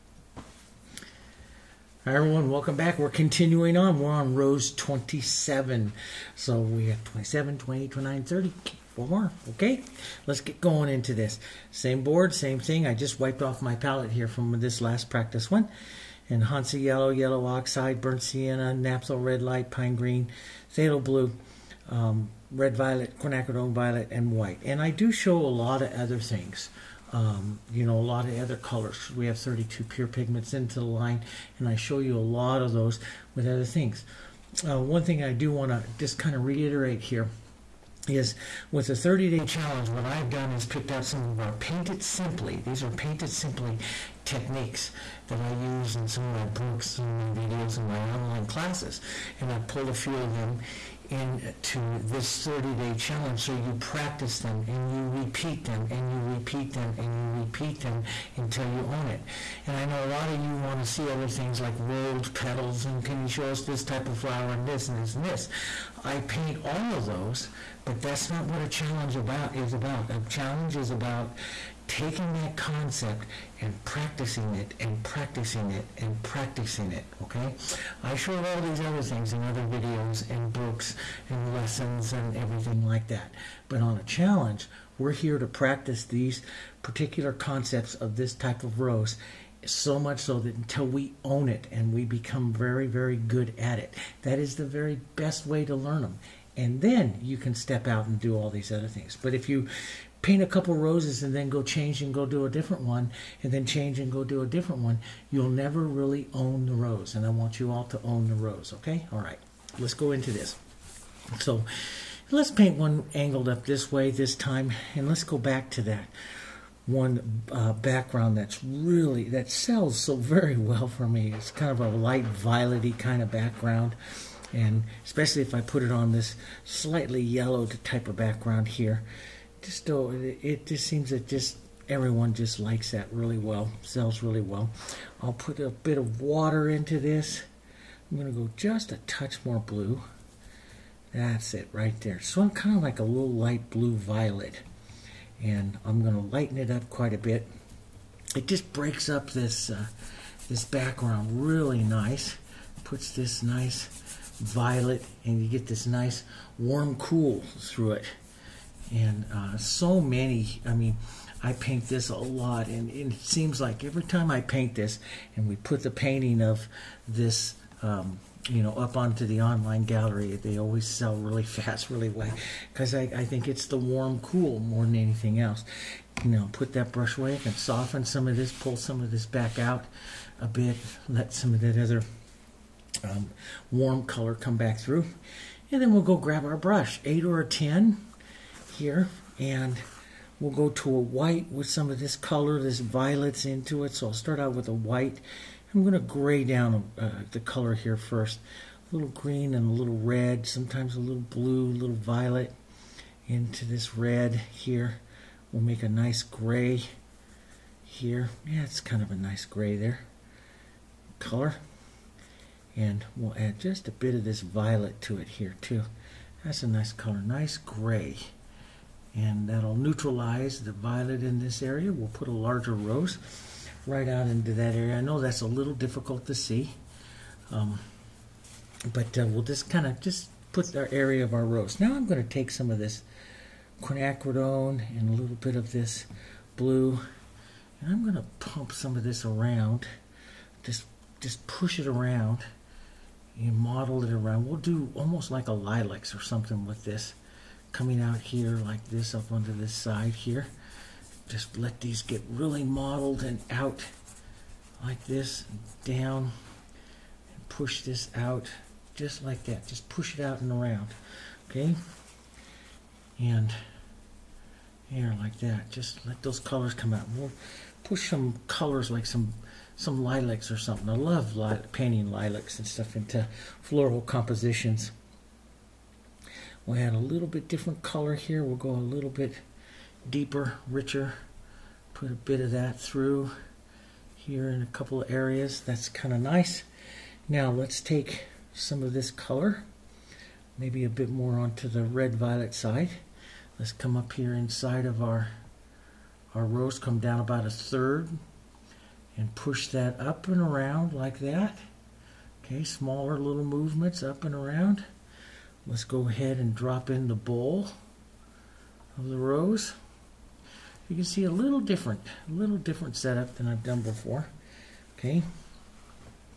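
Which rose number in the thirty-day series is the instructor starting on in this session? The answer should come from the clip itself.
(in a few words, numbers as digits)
27.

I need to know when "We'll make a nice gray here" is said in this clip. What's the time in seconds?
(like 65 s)
205 s.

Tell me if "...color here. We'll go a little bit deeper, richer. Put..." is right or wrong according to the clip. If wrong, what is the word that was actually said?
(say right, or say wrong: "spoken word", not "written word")
right.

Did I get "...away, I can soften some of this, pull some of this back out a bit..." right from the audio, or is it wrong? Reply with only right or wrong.
right.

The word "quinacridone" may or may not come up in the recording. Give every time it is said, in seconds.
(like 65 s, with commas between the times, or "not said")
23 s, 233 s.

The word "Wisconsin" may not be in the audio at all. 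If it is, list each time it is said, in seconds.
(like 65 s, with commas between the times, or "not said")
not said.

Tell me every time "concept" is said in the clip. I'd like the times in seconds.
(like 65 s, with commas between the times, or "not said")
72 s, 87 s.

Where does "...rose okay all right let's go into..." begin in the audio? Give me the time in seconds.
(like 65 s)
108 s.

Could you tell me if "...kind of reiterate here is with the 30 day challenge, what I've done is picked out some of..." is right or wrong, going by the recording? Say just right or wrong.
right.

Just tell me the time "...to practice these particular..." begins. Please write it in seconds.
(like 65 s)
85 s.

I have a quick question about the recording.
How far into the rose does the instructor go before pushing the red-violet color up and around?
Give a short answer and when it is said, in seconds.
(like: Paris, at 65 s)
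About a third, at 297 s.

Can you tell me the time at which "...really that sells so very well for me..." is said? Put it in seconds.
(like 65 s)
118 s.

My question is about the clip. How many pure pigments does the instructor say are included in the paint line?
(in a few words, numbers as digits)
32.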